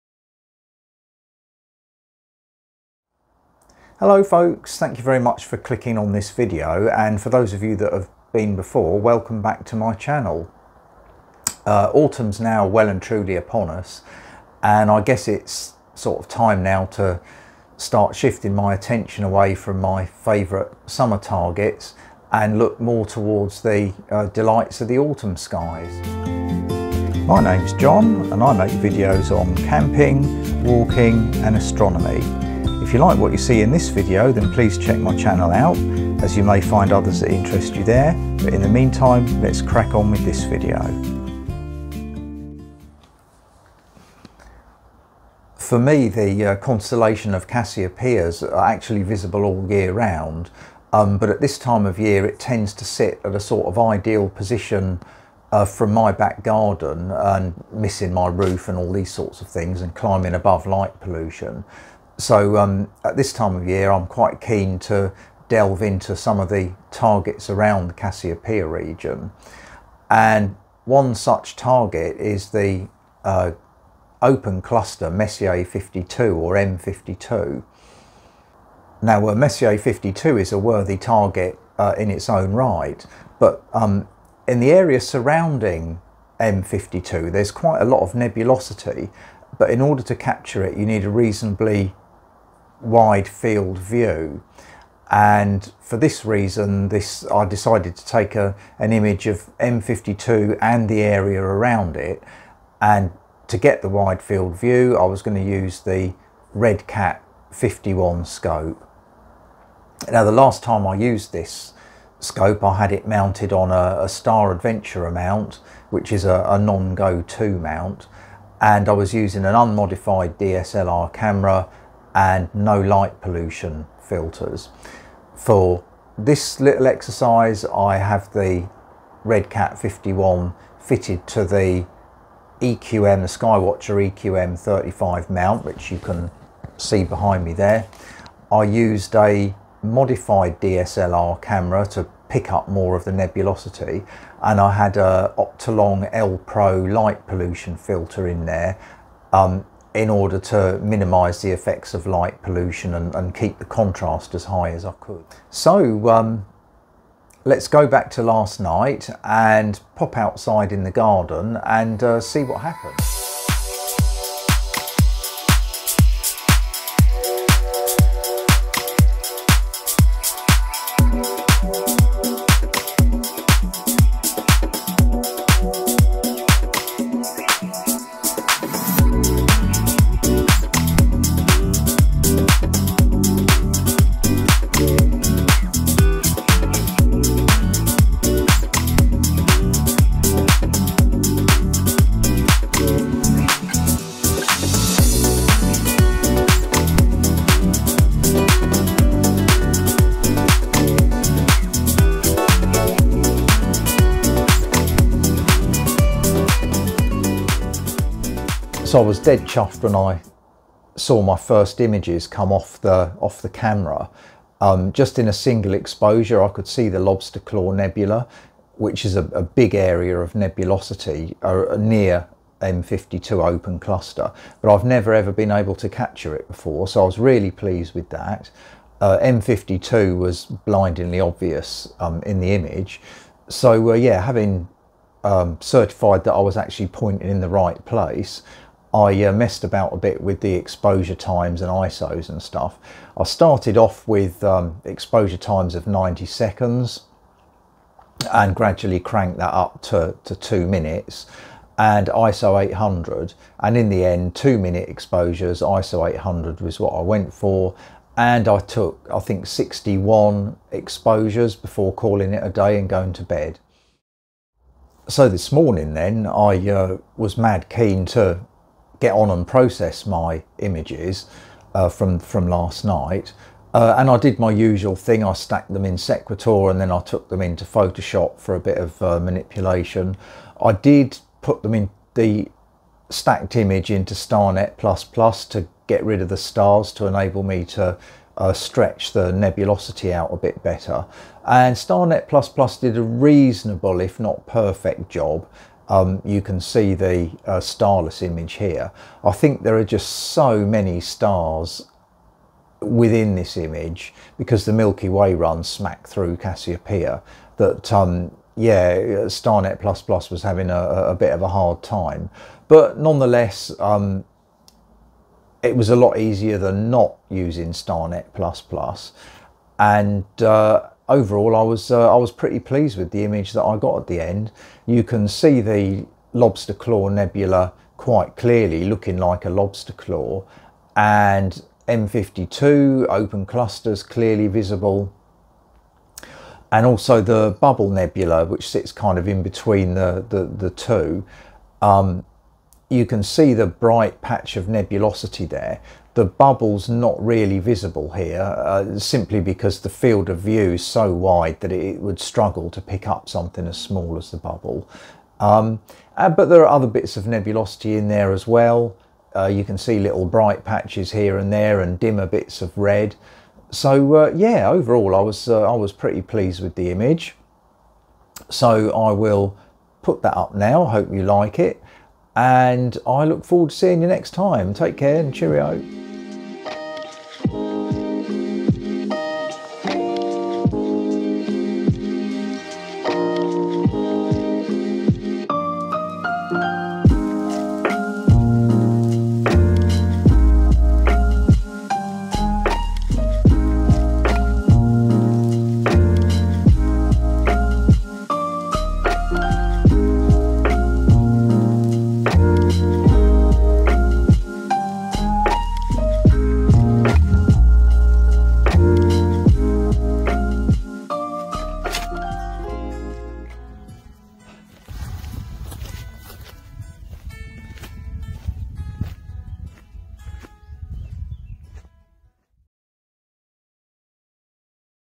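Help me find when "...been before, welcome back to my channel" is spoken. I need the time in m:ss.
0:08.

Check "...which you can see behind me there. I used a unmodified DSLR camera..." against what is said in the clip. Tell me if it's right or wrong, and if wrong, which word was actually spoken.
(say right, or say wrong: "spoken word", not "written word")
wrong: "modified", not "unmodified".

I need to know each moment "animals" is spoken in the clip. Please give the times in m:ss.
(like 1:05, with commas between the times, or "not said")
not said.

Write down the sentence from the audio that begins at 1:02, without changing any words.
So um, at this time of year, I'm quite keen to delve into some of the targets around the Cassiopeia region.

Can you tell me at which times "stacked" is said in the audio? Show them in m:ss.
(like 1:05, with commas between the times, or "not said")
4:35, 4:43.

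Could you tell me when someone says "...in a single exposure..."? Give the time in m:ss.
3:35.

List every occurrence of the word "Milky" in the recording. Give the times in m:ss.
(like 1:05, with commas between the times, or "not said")
5:04.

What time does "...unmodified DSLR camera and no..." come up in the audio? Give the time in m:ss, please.
1:59.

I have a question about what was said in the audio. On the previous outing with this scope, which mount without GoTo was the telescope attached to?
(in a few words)
Star Adventurer.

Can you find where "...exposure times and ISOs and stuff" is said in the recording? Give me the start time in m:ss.
4:00.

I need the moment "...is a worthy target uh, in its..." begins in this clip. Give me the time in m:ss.
1:20.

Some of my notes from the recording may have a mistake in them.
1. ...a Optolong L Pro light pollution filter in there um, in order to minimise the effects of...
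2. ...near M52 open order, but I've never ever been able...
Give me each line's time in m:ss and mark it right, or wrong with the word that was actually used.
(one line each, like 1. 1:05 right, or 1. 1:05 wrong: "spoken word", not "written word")
1. 2:24 right
2. 3:41 wrong: "cluster", not "order".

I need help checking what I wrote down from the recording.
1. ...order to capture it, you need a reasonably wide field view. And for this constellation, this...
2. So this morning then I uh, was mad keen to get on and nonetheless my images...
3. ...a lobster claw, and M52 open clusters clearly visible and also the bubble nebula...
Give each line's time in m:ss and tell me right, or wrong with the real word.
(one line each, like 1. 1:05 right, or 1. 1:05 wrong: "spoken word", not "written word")
1. 1:29 wrong: "reason", not "constellation"
2. 4:25 wrong: "process", not "nonetheless"
3. 5:29 right.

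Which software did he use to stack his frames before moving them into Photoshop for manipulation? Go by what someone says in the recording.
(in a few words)
Sequator.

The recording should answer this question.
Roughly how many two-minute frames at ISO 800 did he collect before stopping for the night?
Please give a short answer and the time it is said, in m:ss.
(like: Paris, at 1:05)
61, at 4:19.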